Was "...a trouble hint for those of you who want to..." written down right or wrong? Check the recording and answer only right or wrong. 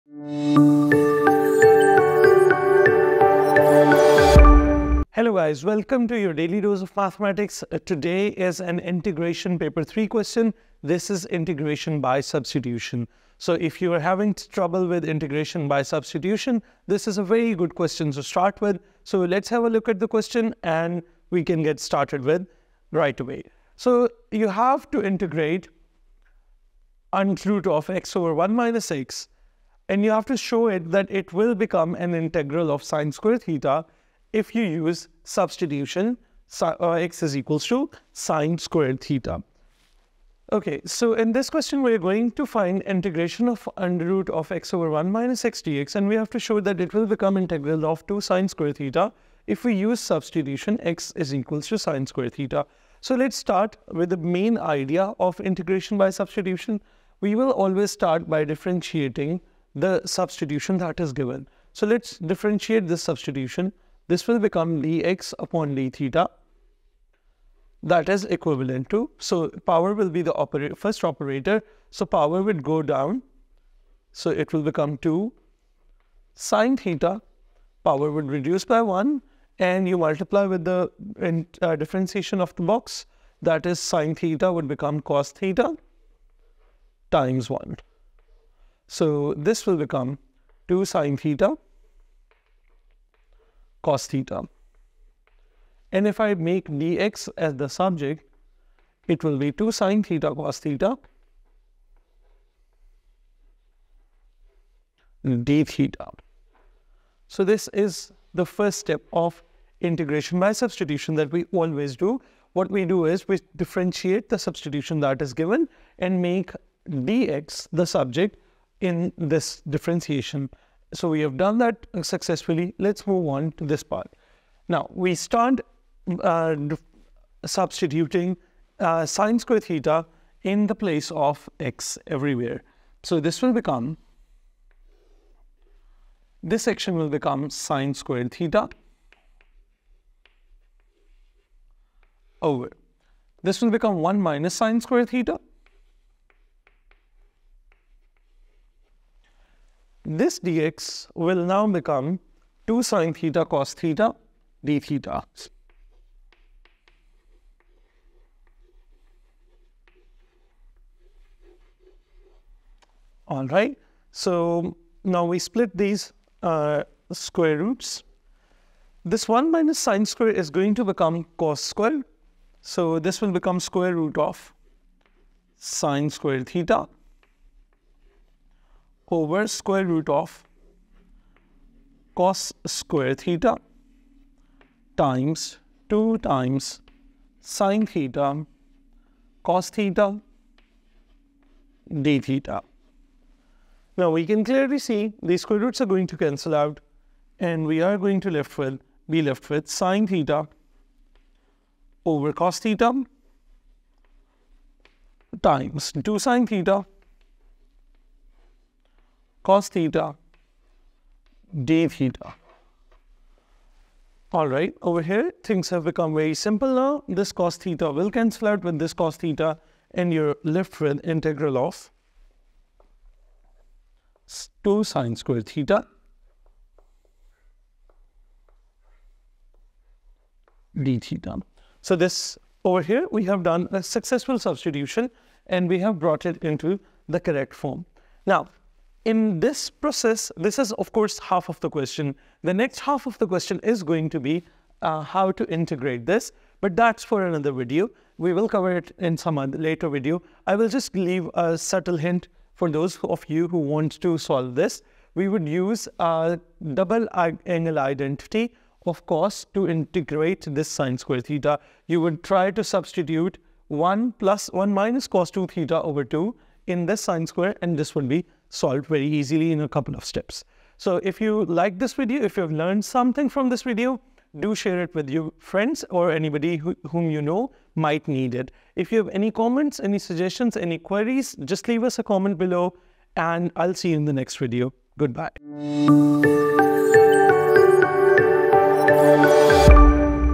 wrong.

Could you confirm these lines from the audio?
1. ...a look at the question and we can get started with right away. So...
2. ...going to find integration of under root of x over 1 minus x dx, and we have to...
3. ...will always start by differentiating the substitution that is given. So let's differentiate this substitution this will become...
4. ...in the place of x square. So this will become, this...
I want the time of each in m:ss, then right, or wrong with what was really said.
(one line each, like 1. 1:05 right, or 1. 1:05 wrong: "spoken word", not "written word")
1. 0:19 right
2. 0:41 right
3. 0:57 right
4. 2:10 wrong: "everywhere", not "square".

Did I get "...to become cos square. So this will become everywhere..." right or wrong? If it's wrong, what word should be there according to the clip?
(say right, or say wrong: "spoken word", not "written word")
wrong: "square", not "everywhere".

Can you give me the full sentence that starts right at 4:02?
The next half of the question is going to be uh, how to integrate this, but that's for another video.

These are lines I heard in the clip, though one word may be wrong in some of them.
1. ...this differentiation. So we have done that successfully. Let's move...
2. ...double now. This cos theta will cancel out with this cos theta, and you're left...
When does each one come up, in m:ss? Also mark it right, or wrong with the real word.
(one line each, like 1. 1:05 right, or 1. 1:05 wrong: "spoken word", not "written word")
1. 1:59 right
2. 3:36 wrong: "simple", not "double".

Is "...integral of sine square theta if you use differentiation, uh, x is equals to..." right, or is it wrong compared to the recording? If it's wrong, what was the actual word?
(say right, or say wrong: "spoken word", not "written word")
wrong: "substitution", not "differentiation".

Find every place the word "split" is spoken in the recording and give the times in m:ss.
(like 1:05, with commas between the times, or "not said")
2:45.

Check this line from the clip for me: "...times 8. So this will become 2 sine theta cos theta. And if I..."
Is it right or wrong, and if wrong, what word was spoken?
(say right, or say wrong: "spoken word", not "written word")
wrong: "1", not "8".